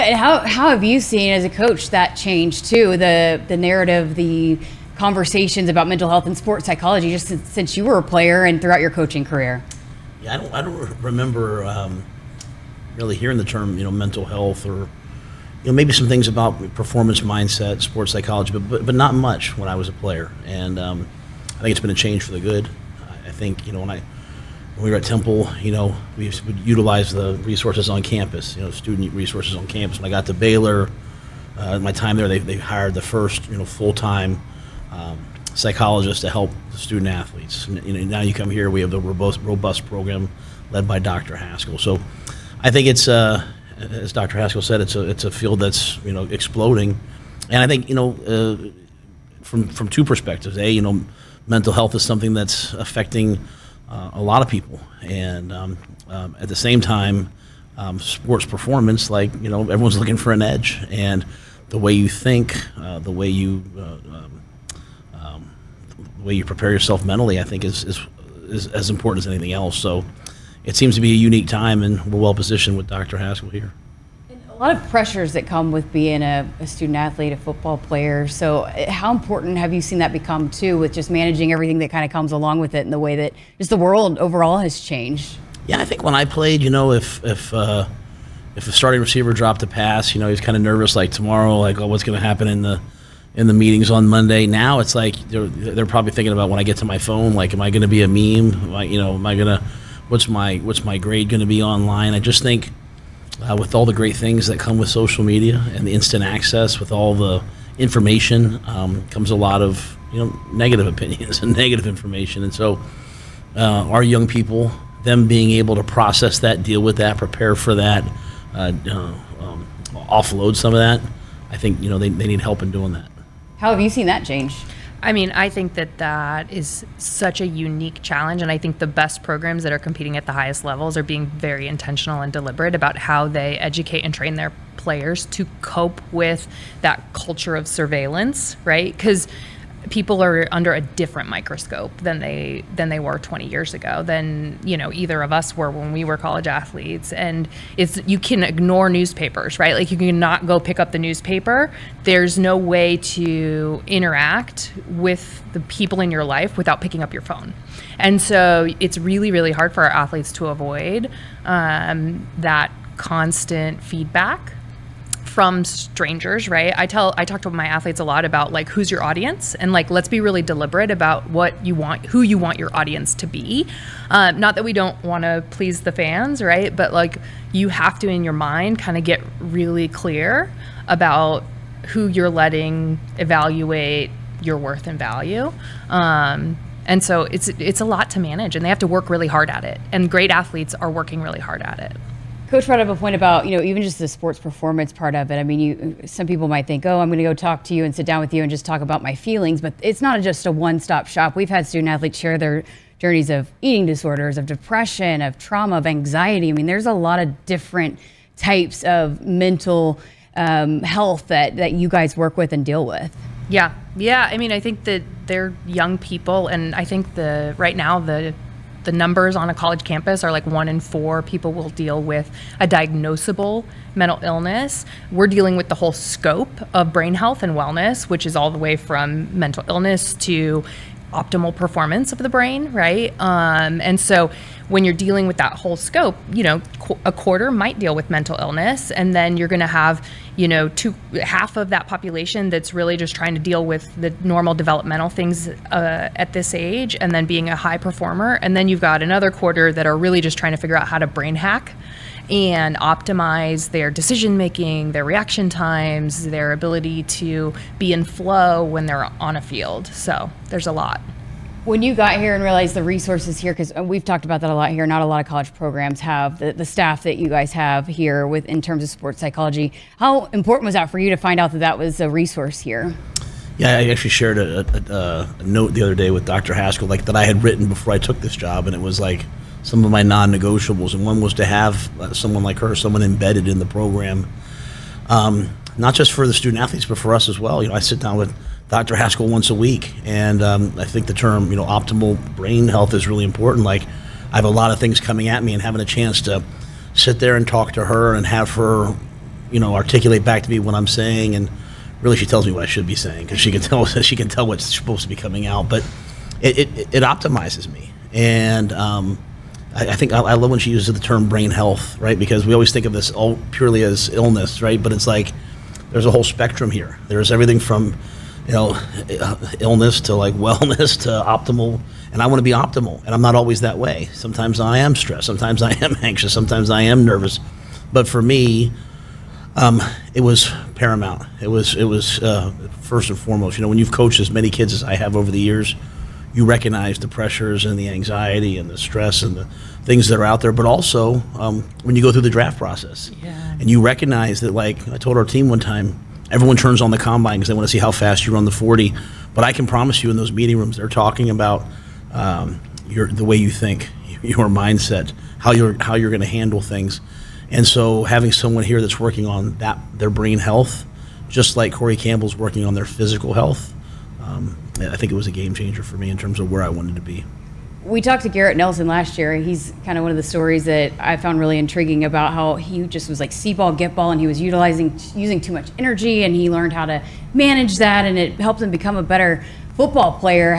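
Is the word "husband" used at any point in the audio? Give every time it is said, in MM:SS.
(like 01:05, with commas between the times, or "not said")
not said.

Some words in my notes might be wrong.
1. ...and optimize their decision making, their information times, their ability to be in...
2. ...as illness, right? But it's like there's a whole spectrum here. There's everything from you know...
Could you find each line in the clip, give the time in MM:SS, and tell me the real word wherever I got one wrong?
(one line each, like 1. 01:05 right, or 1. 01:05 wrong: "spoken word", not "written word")
1. 04:12 wrong: "reaction", not "information"
2. 05:13 right.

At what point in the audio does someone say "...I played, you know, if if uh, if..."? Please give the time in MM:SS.
01:26.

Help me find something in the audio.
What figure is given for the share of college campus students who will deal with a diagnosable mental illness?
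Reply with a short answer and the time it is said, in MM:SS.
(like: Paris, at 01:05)
1 in 4, at 03:40.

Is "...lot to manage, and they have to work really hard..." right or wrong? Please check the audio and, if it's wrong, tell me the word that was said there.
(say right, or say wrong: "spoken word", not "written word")
right.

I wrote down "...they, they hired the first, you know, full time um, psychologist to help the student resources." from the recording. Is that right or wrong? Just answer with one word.
wrong.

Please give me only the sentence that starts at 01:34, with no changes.
Now it's like they're, they're probably thinking about when I get to my phone, like, am I going to be a meme?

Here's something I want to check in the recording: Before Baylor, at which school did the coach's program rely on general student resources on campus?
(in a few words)
Temple.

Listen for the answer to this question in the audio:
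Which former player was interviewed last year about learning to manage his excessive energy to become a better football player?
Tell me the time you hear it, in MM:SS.
06:08.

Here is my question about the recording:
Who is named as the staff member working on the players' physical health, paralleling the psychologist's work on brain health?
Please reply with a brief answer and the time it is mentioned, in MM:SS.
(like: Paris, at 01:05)
Corey Campbell, at 06:01.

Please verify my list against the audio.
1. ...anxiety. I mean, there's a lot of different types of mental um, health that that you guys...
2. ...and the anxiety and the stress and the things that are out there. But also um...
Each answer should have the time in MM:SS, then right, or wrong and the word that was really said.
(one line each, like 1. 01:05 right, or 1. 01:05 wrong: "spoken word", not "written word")
1. 03:25 right
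2. 05:37 right.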